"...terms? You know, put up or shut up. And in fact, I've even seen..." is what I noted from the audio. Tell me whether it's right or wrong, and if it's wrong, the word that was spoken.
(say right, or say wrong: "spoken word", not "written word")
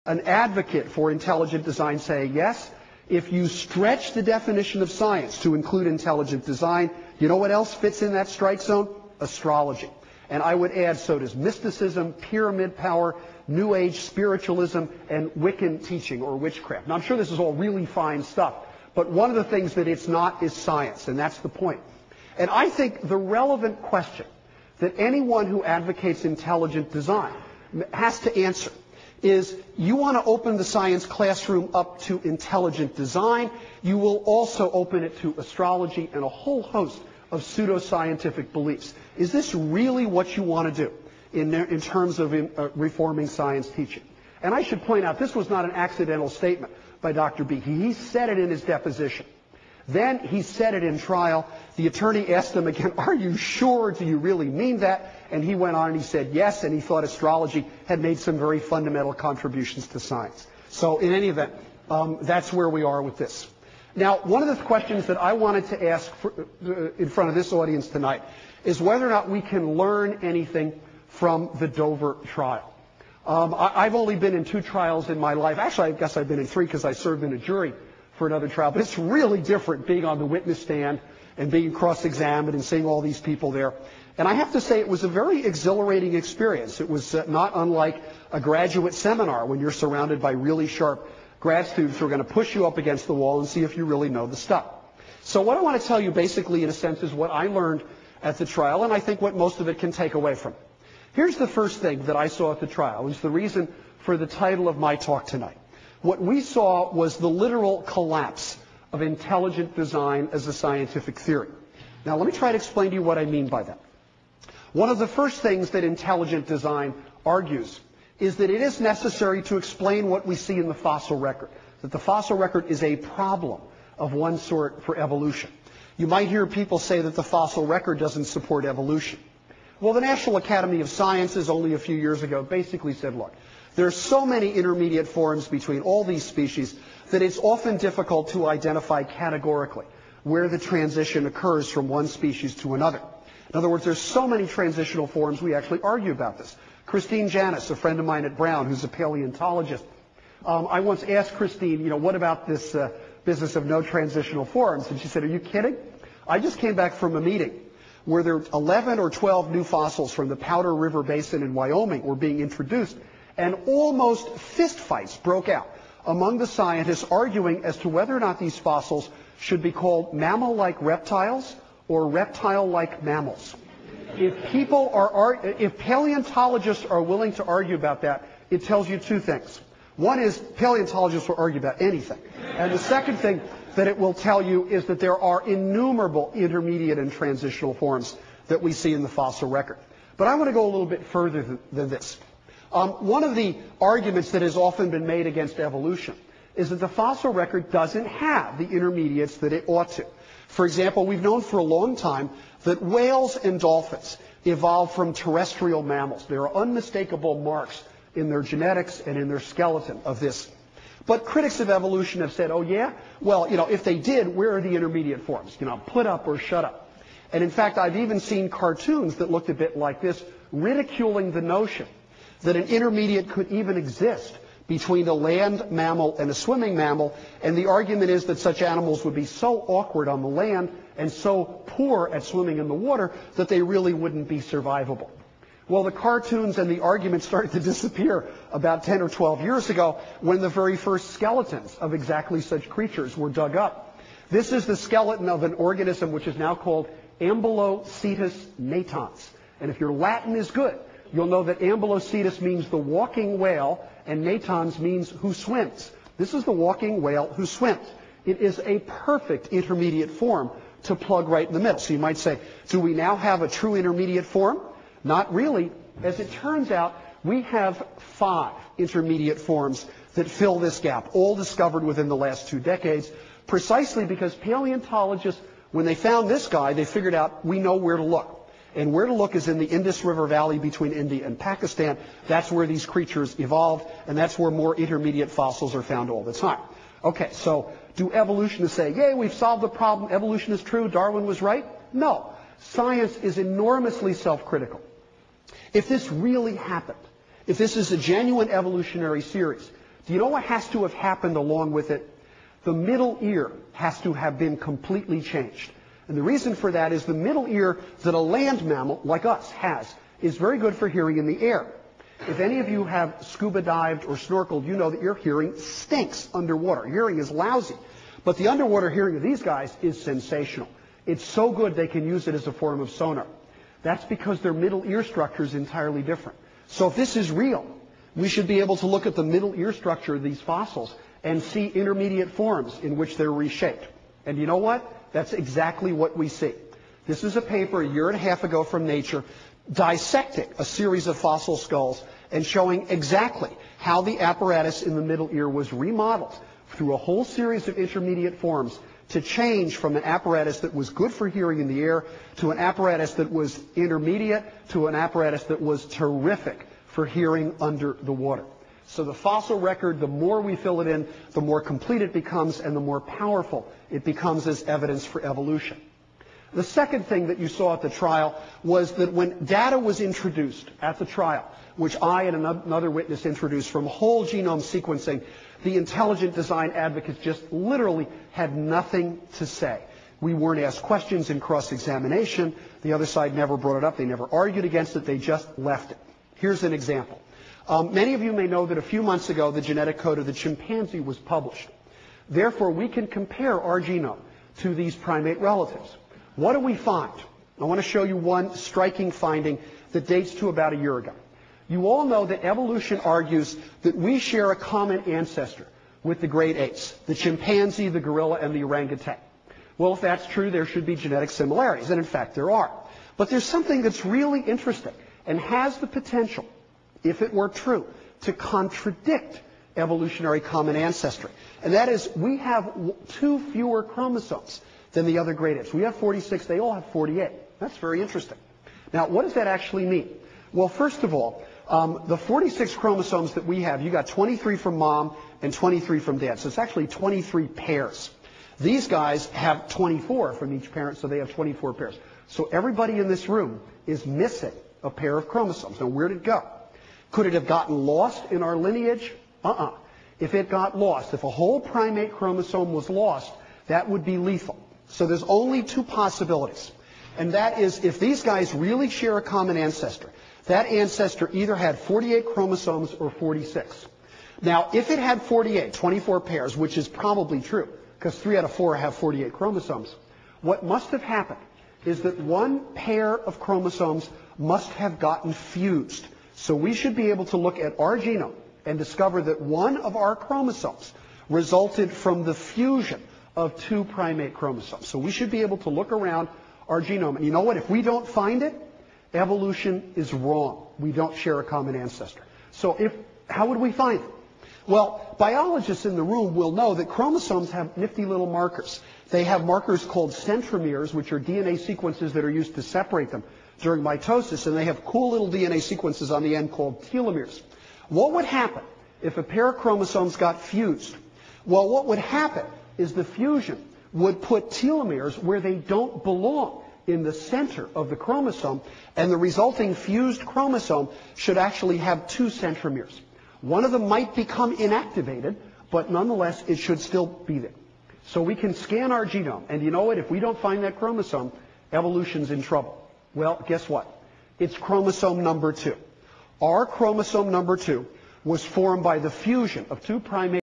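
wrong: "forms", not "terms".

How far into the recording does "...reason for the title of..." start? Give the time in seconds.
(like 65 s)
103 s.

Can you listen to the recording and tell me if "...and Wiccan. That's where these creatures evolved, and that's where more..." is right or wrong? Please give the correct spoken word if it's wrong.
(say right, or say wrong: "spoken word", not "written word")
wrong: "Pakistan", not "Wiccan".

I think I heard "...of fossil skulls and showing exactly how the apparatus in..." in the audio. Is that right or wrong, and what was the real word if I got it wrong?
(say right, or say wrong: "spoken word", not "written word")
right.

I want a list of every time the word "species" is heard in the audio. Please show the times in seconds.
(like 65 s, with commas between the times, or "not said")
136 s, 142 s.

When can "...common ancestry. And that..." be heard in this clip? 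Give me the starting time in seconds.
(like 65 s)
420 s.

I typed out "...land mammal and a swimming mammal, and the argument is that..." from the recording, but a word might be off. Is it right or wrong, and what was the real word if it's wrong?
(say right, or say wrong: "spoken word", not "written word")
right.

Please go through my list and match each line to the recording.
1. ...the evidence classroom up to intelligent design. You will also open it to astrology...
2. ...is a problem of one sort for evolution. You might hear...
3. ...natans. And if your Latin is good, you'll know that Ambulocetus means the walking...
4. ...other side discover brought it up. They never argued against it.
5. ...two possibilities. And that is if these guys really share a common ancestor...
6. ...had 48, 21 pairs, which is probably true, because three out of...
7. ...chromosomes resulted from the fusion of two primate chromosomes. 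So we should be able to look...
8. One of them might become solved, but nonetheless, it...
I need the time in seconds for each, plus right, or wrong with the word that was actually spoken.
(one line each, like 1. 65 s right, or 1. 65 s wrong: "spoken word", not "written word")
1. 30 s wrong: "science", not "evidence"
2. 122 s right
3. 248 s right
4. 382 s wrong: "never", not "discover"
5. 455 s right
6. 464 s wrong: "24", not "21"
7. 480 s right
8. 523 s wrong: "inactivated", not "solved".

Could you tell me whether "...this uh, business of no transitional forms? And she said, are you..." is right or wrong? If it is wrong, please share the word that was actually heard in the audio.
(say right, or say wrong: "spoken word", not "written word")
right.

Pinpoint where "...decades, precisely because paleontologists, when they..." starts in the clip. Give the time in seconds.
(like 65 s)
272 s.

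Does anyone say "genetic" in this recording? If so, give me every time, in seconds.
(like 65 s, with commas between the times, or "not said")
208 s, 389 s, 410 s.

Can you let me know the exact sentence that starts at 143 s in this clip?
In other words, there's so many transitional forms, we actually argue about this.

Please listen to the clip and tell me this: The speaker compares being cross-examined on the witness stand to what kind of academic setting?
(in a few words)
A graduate seminar.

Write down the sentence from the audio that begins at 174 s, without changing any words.
If people are, if paleontologists are willing to argue about that, it tells you two things.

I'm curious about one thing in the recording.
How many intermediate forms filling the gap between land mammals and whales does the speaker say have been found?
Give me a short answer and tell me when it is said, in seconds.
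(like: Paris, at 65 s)
5, at 267 s.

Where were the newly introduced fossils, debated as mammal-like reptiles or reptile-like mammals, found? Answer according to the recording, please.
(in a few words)
Powder River Basin.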